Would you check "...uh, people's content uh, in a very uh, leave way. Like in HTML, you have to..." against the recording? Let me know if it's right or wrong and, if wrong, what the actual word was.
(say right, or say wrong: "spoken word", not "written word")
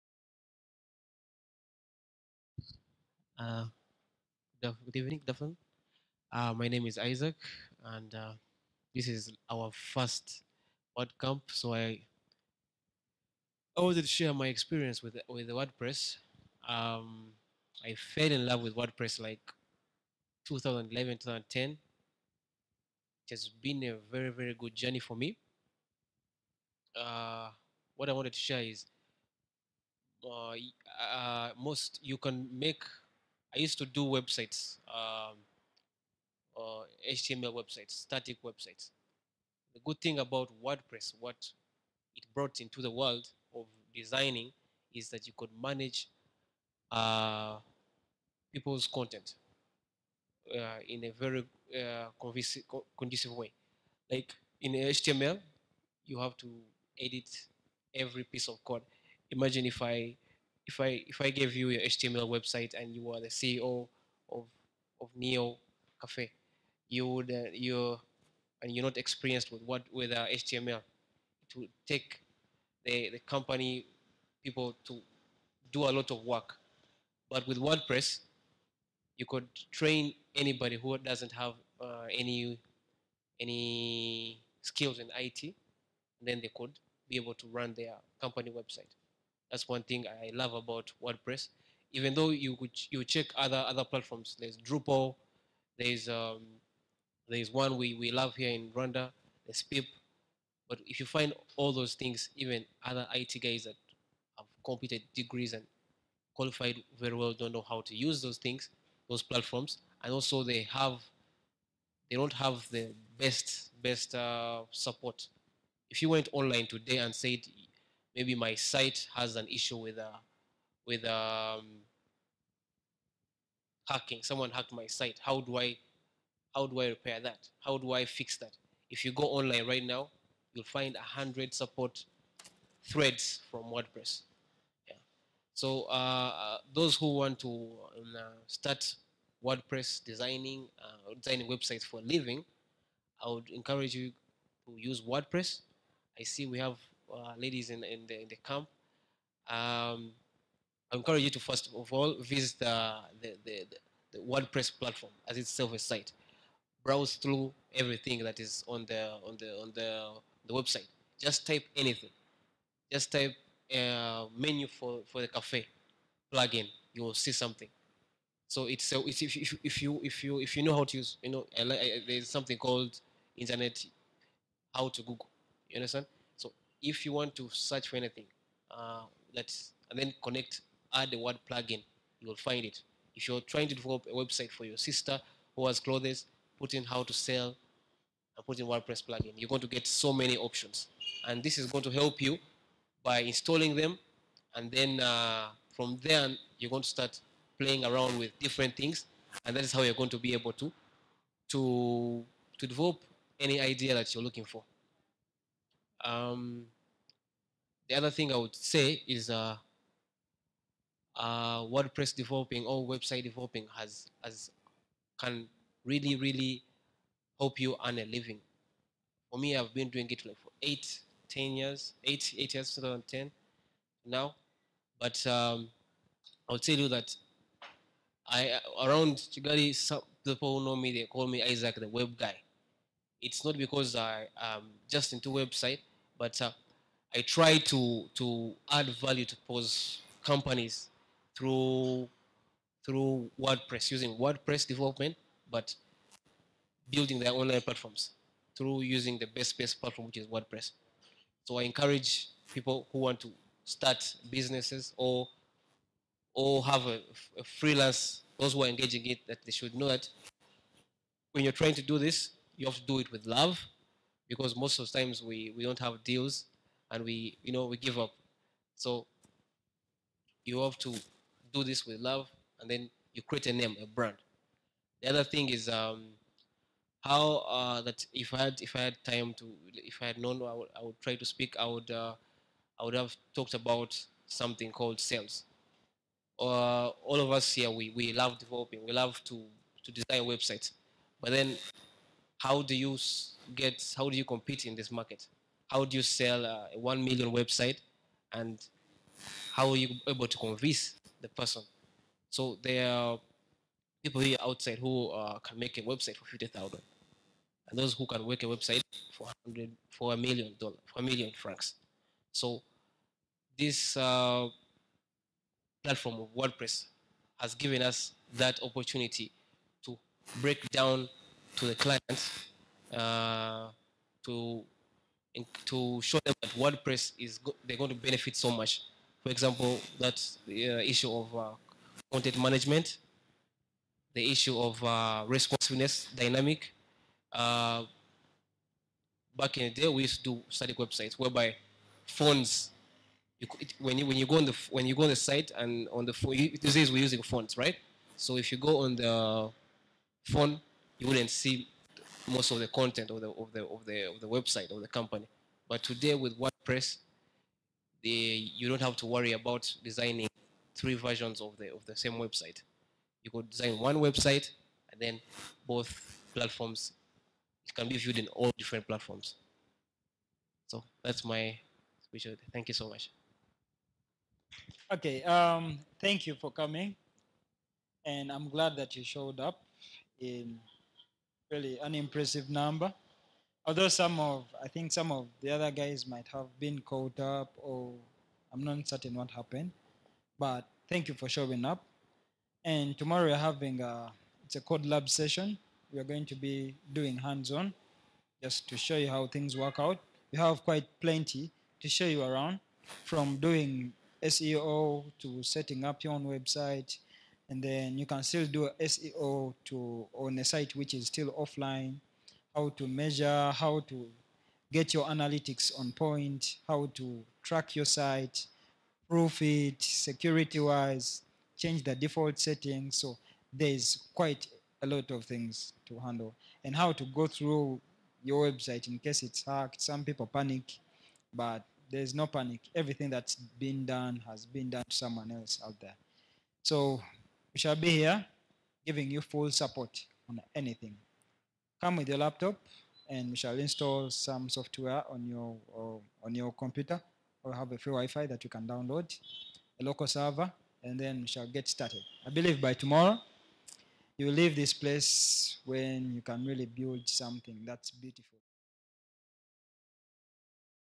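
wrong: "conducive", not "leave".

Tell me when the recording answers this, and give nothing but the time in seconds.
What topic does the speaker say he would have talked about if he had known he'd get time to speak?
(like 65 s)
285 s.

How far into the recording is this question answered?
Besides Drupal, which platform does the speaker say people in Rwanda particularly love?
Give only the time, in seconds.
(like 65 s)
99 s.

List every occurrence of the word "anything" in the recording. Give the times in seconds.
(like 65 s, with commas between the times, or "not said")
161 s, 177 s, 440 s.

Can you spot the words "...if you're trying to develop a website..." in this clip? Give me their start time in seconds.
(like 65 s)
183 s.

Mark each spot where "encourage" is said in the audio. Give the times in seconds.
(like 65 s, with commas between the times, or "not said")
143 s, 150 s, 251 s.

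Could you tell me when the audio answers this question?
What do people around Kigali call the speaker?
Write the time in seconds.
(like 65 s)
231 s.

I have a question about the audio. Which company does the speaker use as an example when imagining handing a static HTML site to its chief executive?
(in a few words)
Neo Cafe.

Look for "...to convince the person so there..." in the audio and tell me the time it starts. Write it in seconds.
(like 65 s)
300 s.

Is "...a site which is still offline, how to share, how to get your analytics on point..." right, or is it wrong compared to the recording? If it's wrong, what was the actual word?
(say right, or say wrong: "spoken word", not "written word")
wrong: "measure", not "share".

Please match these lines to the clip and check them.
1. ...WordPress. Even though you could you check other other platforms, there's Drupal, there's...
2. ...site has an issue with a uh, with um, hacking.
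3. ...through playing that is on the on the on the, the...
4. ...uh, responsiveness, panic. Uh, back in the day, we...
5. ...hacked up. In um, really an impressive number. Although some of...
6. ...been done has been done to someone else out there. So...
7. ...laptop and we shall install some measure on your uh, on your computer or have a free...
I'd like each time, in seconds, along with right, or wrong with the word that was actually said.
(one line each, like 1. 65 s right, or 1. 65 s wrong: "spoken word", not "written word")
1. 91 s right
2. 118 s right
3. 157 s wrong: "everything", not "playing"
4. 334 s wrong: "dynamic", not "panic"
5. 379 s wrong: "showed", not "hacked"
6. 433 s right
7. 442 s wrong: "software", not "measure".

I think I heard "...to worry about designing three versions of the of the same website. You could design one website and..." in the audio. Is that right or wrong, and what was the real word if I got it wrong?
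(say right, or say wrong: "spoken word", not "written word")
right.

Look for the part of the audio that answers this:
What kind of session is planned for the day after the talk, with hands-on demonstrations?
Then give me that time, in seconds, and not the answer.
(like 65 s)
394 s.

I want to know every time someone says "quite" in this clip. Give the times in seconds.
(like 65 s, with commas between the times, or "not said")
400 s, 424 s.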